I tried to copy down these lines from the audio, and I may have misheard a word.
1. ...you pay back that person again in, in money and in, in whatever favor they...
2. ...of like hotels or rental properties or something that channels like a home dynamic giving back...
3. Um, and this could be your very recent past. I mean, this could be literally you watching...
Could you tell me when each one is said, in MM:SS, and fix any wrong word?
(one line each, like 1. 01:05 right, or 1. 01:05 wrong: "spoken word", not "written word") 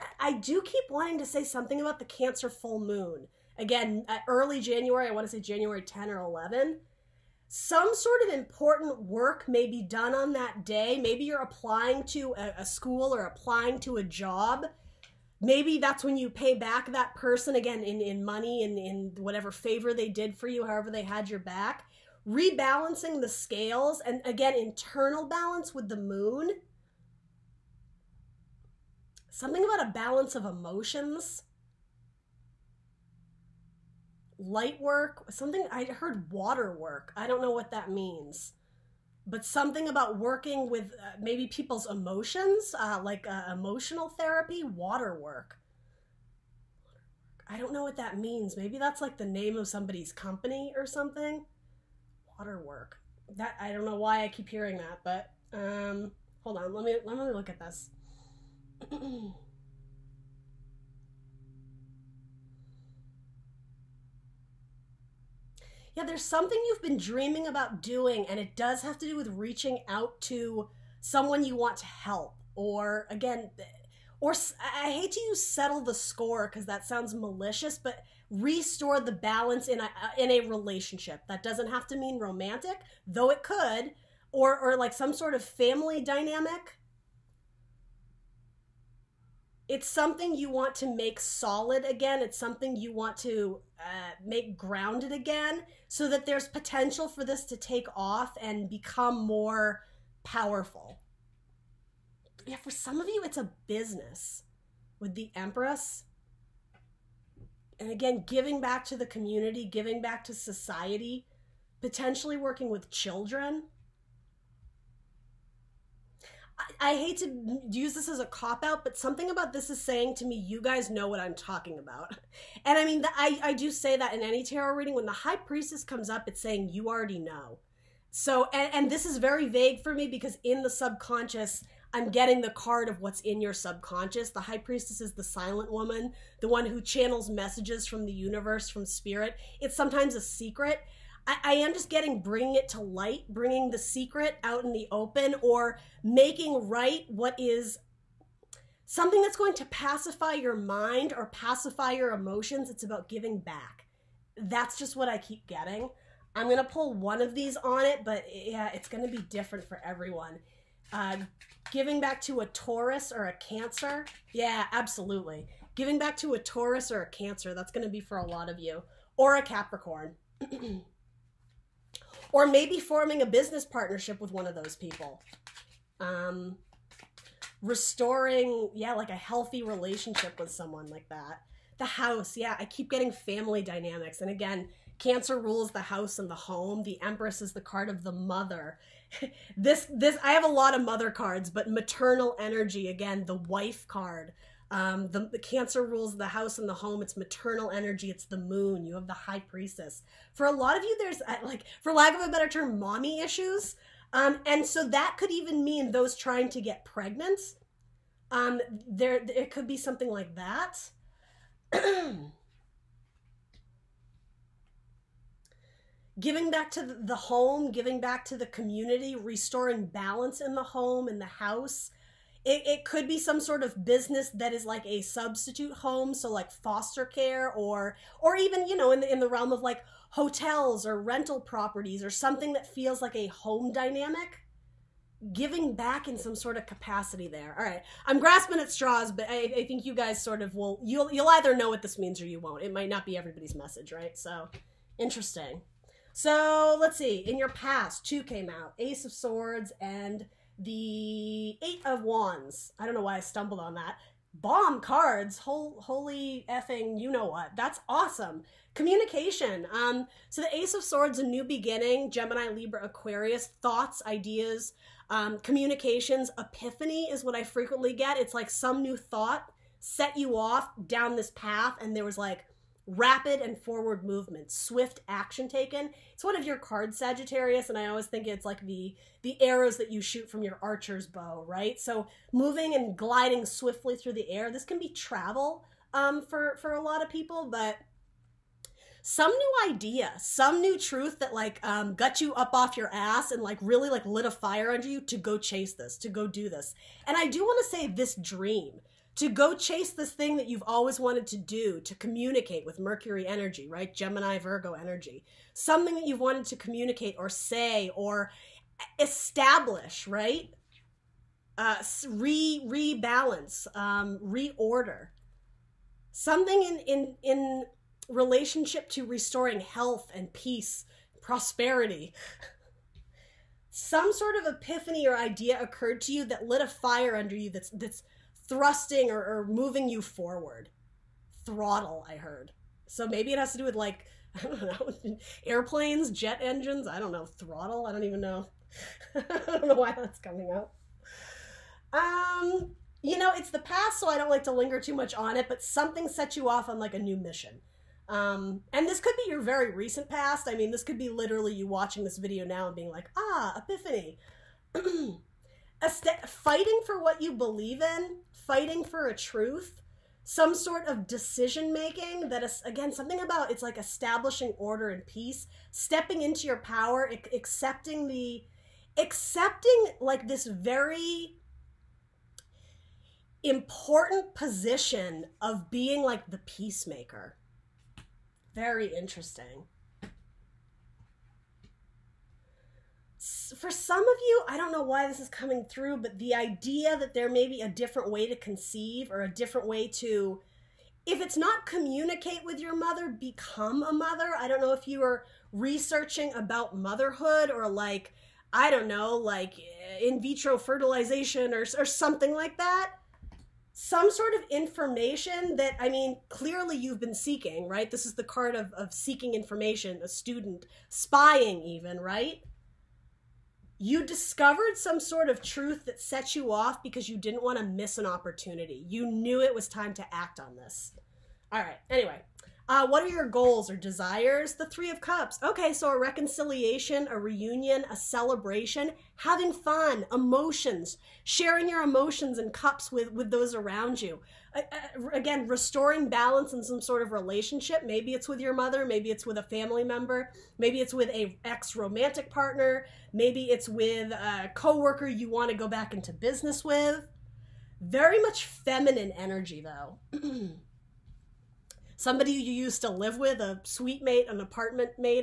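1. 00:16 right
2. 03:49 wrong: "feels", not "channels"
3. 05:48 right.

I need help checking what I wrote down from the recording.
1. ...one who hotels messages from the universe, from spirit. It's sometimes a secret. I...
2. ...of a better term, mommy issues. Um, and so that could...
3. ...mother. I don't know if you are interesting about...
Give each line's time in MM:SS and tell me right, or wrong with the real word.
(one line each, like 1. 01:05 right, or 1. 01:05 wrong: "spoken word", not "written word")
1. 02:16 wrong: "channels", not "hotels"
2. 03:22 right
3. 06:33 wrong: "researching", not "interesting".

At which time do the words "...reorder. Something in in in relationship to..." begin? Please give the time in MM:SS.
05:14.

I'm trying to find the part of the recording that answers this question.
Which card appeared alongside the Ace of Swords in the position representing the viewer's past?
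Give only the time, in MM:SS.
04:11.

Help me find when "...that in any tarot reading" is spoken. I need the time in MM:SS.
02:03.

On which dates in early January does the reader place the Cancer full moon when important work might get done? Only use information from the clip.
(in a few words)
January 10 or 11.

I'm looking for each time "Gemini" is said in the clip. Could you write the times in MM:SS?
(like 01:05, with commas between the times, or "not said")
04:22, 05:03.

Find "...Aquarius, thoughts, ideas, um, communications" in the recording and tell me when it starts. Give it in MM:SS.
04:22.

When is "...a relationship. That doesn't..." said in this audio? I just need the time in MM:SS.
01:20.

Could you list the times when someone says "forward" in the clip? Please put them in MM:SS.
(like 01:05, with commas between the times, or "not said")
04:33, 05:30.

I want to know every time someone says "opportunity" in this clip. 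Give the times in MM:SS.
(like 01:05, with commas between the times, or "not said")
06:58.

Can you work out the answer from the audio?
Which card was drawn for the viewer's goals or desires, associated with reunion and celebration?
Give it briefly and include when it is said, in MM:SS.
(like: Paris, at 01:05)
Three of Cups, at 07:04.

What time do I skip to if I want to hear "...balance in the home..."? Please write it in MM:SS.
03:39.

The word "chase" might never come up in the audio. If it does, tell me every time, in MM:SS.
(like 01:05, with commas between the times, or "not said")
04:55, 04:59.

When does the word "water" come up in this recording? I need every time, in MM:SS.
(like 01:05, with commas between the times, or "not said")
00:36, 00:44, 00:52.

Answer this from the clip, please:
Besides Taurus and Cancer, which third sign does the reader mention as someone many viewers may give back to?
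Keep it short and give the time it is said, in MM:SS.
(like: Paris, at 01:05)
Capricorn, at 02:49.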